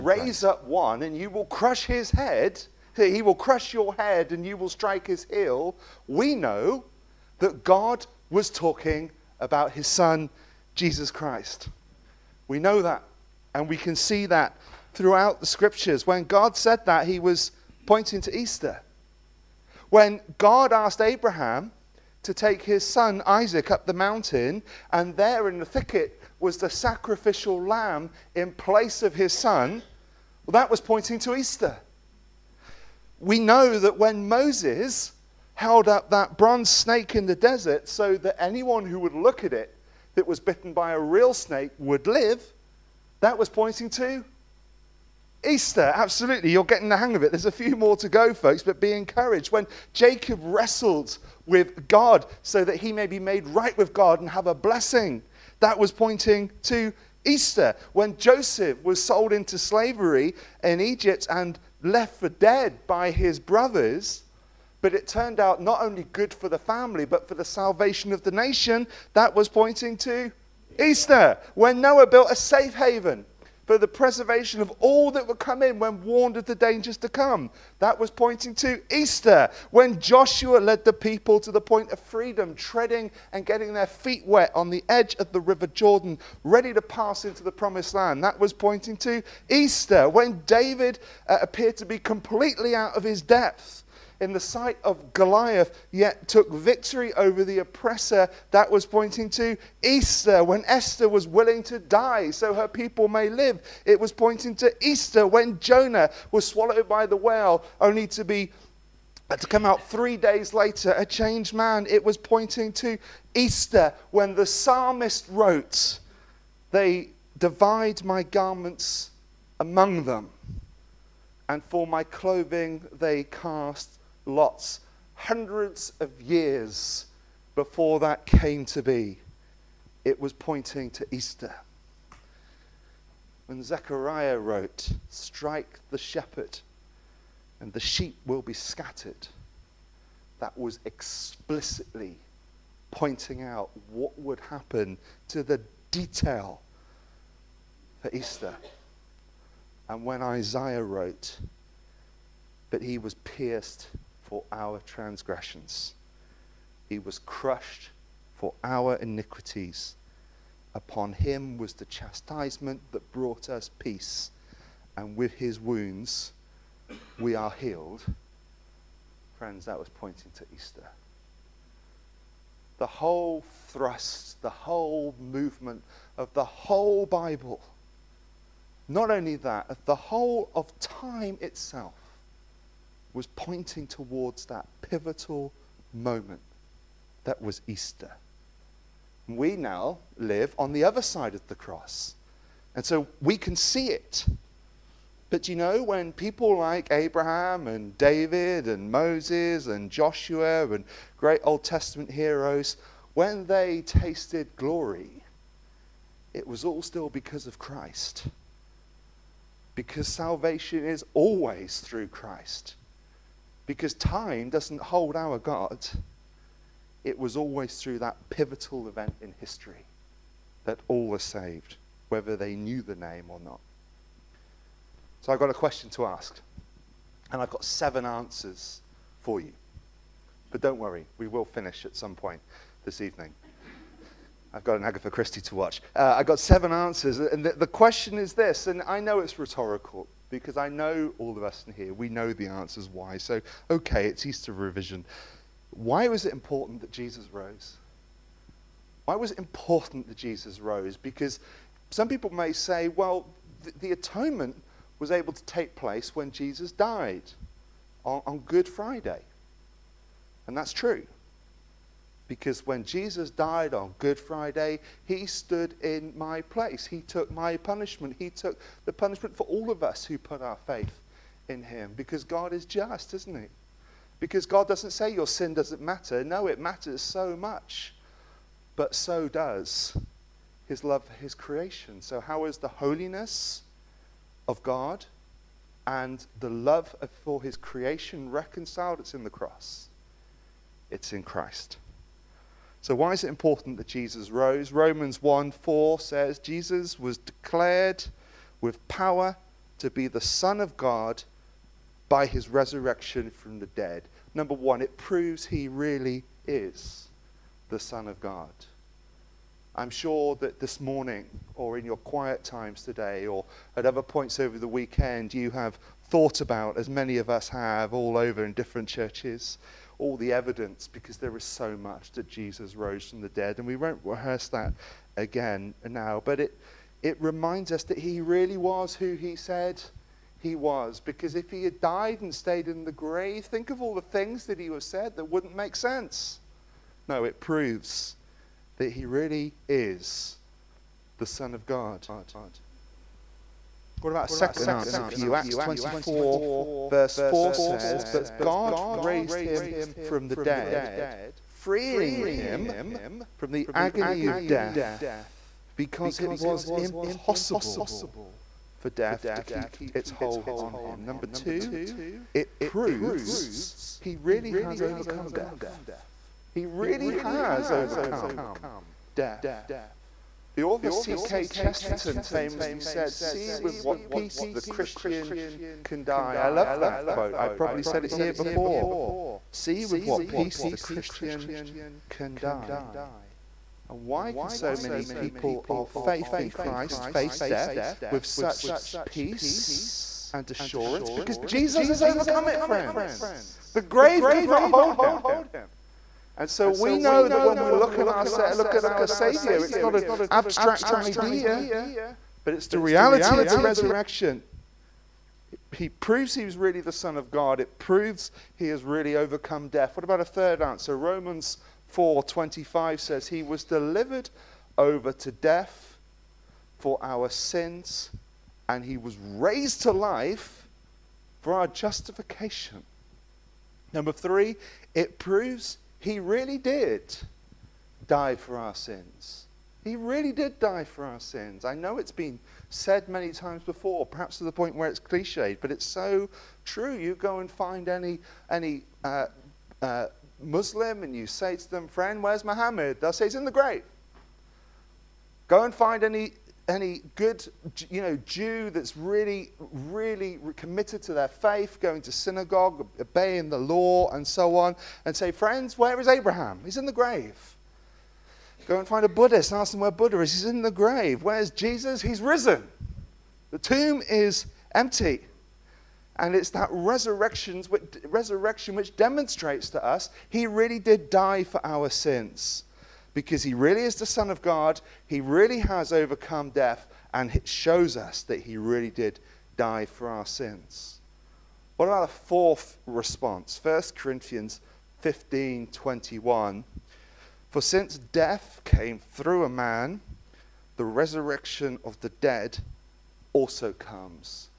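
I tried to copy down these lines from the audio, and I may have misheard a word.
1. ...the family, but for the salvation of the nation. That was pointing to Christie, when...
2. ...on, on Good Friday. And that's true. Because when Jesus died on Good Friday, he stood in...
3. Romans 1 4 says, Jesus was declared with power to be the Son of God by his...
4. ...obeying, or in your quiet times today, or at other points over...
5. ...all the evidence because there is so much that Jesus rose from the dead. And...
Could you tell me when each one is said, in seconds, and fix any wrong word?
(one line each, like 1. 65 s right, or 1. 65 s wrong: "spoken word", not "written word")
1. 66 s wrong: "Easter", not "Christie"
2. 258 s right
3. 294 s right
4. 310 s wrong: "morning", not "obeying"
5. 319 s right.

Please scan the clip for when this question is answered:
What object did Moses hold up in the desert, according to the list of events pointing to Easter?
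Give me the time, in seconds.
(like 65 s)
36 s.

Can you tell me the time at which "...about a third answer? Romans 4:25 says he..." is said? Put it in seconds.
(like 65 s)
410 s.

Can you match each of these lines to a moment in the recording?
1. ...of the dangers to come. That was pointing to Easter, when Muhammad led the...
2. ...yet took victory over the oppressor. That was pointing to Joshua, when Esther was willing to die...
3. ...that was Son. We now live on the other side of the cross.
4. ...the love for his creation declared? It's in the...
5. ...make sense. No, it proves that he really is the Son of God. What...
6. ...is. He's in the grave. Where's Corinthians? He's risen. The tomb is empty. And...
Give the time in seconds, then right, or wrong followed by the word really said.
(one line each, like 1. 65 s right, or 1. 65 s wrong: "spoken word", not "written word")
1. 76 s wrong: "Joshua", not "Muhammad"
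2. 95 s wrong: "Easter", not "Joshua"
3. 187 s wrong: "Easter", not "Son"
4. 286 s wrong: "reconciled", not "declared"
5. 335 s right
6. 460 s wrong: "Jesus", not "Corinthians".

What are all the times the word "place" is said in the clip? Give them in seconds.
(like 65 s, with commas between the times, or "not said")
28 s, 255 s, 266 s.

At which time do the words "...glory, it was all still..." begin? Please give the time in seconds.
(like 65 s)
204 s.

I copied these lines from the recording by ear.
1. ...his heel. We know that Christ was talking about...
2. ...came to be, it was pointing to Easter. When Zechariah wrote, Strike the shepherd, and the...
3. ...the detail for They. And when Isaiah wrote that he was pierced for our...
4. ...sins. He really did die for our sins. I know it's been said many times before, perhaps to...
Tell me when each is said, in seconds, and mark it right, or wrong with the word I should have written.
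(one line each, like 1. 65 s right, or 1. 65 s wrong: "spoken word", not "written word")
1. 5 s wrong: "God", not "Christ"
2. 128 s right
3. 145 s wrong: "Easter", not "They"
4. 428 s right.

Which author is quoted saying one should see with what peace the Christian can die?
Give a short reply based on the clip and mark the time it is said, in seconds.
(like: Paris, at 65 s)
G.K. Chesterton, at 370 s.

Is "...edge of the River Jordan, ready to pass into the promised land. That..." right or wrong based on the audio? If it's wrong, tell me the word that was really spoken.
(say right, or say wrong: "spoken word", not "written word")
right.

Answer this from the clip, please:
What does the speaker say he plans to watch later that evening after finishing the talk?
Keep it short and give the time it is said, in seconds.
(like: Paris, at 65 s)
An Agatha Christie, at 234 s.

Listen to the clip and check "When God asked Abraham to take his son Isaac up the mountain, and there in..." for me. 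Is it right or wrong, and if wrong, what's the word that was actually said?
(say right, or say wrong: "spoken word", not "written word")
right.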